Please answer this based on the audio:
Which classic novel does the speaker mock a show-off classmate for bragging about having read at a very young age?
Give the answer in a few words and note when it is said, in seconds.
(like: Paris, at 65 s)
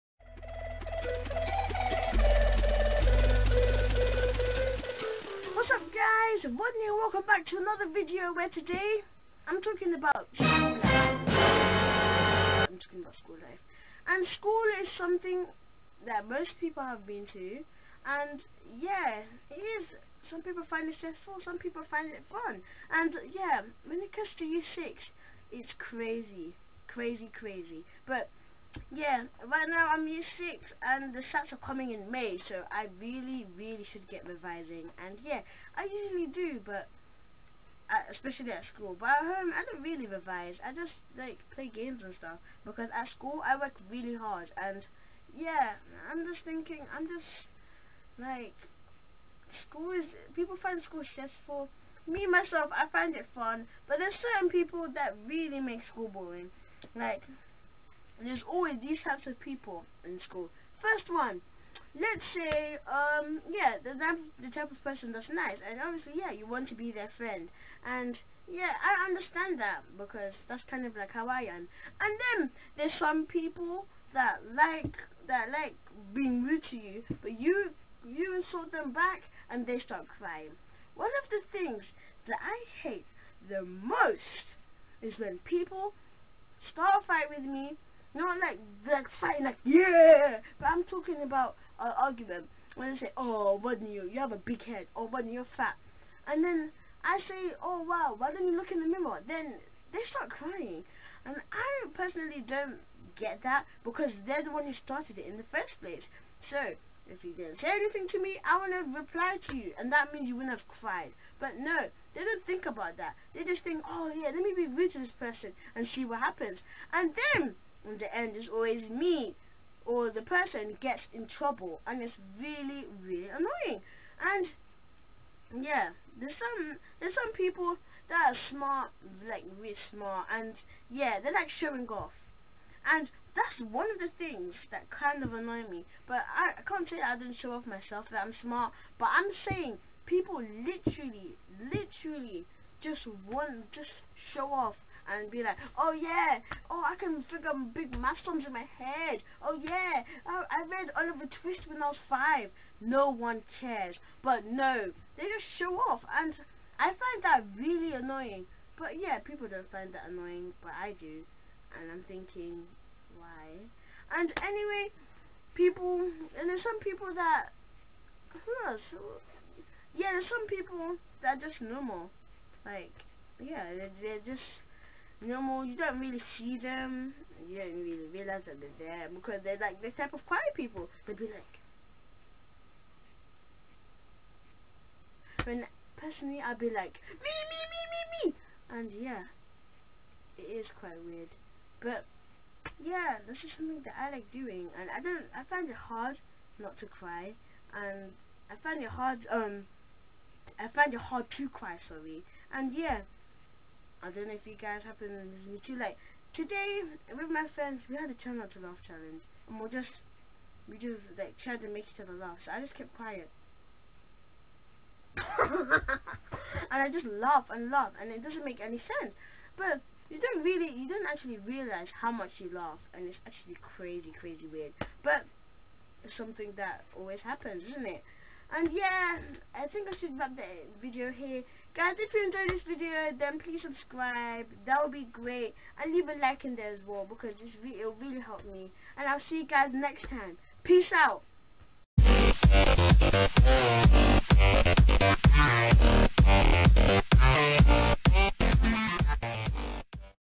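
Oliver Twist, at 150 s.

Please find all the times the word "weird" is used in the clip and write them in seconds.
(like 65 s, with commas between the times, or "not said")
191 s, 224 s.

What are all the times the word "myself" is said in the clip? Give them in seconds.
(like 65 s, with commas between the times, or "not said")
52 s, 137 s.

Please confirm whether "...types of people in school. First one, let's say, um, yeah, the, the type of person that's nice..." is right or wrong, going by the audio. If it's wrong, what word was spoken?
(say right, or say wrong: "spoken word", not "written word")
right.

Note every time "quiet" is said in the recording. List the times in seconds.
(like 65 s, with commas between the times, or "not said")
180 s, 212 s.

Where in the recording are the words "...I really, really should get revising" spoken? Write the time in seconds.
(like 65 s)
32 s.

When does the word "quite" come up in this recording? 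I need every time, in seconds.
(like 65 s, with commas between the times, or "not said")
190 s.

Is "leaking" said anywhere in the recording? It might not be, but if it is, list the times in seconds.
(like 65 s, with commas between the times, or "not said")
not said.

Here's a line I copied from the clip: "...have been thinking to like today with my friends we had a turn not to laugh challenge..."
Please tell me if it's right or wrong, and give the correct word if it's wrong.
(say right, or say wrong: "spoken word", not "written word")
wrong: "listening", not "thinking".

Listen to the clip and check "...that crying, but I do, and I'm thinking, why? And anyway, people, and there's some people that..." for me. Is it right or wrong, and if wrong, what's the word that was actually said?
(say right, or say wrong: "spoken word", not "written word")
wrong: "annoying", not "crying".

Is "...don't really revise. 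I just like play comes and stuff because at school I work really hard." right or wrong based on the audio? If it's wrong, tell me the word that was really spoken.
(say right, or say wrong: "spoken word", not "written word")
wrong: "games", not "comes".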